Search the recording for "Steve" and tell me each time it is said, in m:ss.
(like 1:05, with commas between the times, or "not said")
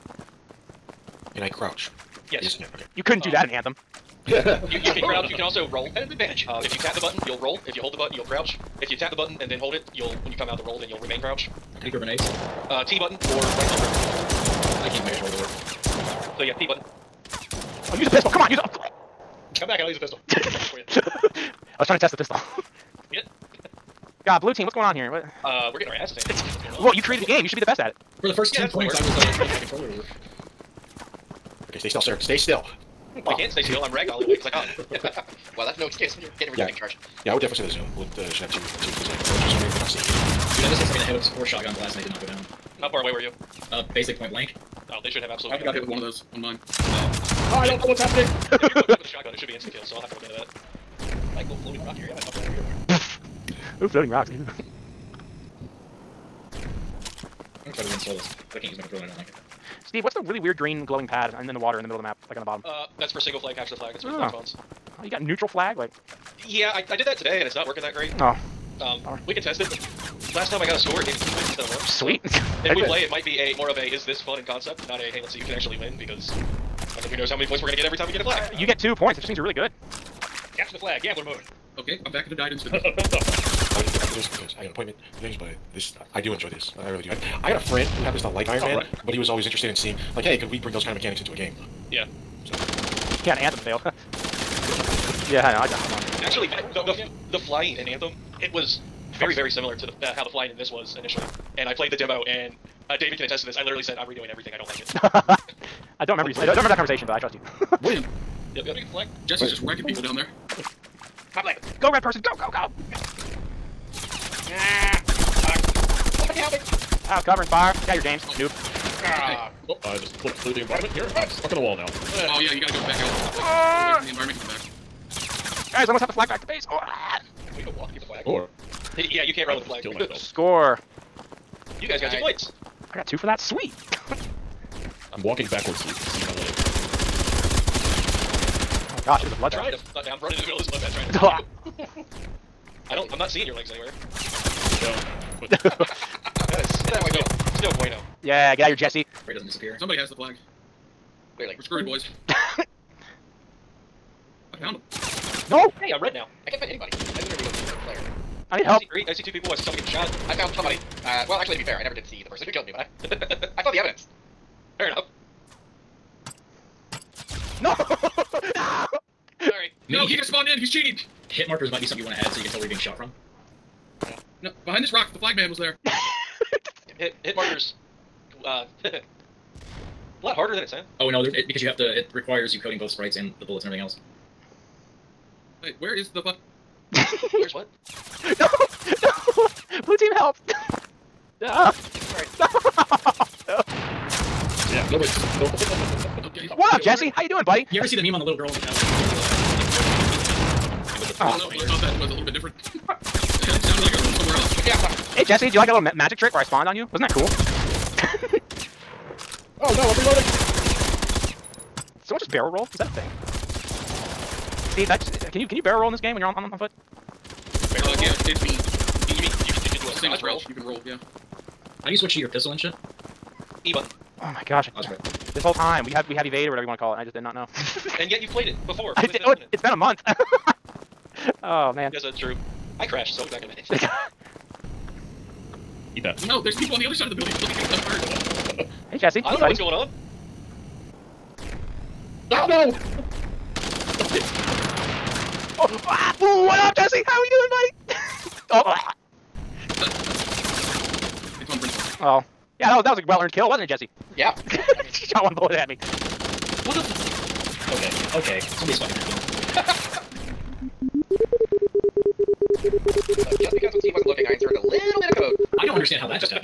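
0:59, 3:34, 4:23.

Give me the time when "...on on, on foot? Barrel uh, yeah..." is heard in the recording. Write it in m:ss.
3:36.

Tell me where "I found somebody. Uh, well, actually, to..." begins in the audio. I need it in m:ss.
2:40.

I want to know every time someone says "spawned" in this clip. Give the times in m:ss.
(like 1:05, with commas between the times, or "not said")
2:50, 3:26.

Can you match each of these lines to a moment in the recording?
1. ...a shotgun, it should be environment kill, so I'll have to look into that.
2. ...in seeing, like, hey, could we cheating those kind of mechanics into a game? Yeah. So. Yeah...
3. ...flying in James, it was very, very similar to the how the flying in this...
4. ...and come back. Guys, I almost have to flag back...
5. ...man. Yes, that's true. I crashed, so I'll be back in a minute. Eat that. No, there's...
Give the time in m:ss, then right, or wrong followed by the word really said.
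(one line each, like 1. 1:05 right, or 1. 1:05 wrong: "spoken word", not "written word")
1. 0:49 wrong: "instant", not "environment"
2. 1:29 wrong: "bring", not "cheating"
3. 1:37 wrong: "Anthem", not "James"
4. 2:04 right
5. 3:51 right.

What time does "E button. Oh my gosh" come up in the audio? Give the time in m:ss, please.
3:43.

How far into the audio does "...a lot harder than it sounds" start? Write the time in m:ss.
2:58.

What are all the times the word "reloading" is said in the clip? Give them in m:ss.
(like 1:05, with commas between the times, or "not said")
3:30.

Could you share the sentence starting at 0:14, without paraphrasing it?
I keep making sure all the work.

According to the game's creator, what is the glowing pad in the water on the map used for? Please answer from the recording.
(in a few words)
Single flag capture the flag.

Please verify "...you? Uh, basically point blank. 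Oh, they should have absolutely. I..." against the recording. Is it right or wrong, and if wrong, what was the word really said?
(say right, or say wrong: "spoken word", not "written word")
right.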